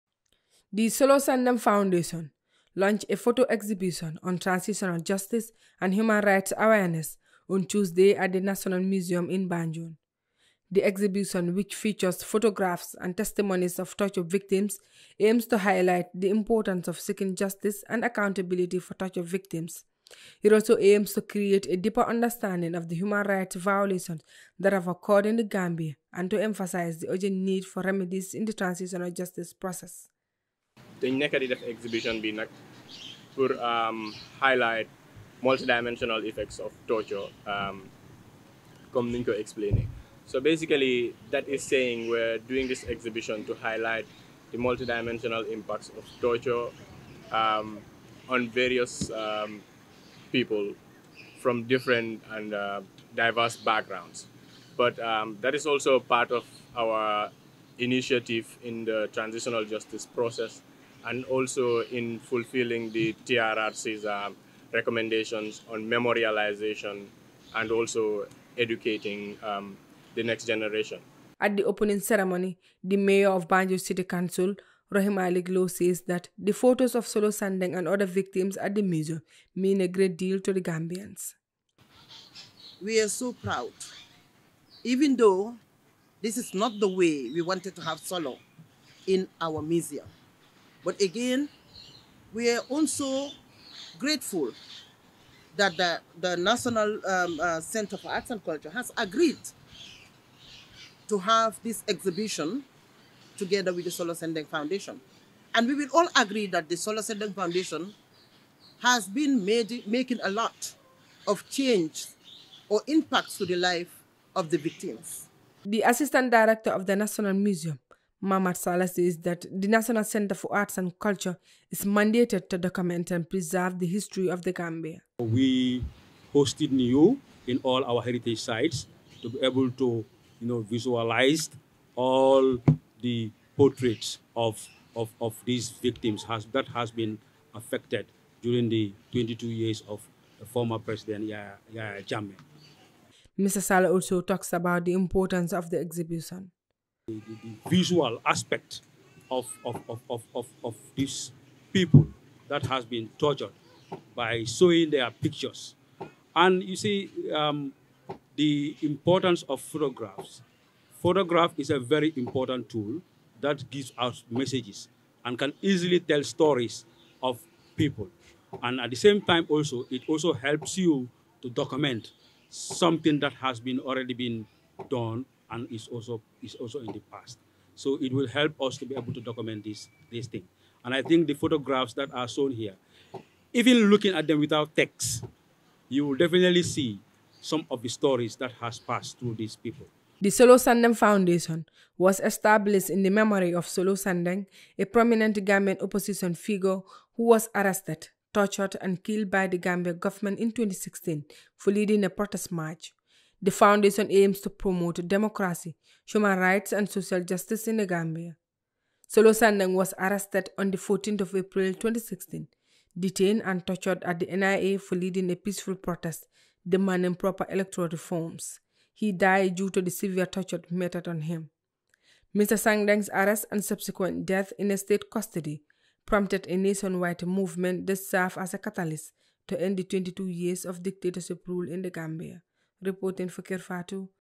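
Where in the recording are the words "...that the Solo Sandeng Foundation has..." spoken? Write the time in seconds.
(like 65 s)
106 s.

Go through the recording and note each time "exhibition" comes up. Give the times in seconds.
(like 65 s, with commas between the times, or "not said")
3 s, 10 s, 31 s, 42 s, 101 s, 145 s.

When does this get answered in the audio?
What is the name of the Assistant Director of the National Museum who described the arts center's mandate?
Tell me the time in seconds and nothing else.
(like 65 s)
118 s.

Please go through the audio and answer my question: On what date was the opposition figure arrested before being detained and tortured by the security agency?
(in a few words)
14 April 2016.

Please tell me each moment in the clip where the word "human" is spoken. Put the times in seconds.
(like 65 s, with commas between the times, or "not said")
5 s, 22 s, 206 s.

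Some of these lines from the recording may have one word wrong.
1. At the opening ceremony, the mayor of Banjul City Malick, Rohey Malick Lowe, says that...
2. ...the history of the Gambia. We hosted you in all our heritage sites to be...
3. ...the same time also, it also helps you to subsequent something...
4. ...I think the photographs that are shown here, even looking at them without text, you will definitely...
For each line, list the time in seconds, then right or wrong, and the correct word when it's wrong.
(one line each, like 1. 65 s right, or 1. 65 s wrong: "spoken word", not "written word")
1. 71 s wrong: "Council", not "Malick"
2. 123 s right
3. 168 s wrong: "document", not "subsequent"
4. 180 s right.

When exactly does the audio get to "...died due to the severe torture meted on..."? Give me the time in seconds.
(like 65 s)
219 s.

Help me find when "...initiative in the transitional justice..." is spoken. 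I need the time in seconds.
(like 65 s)
57 s.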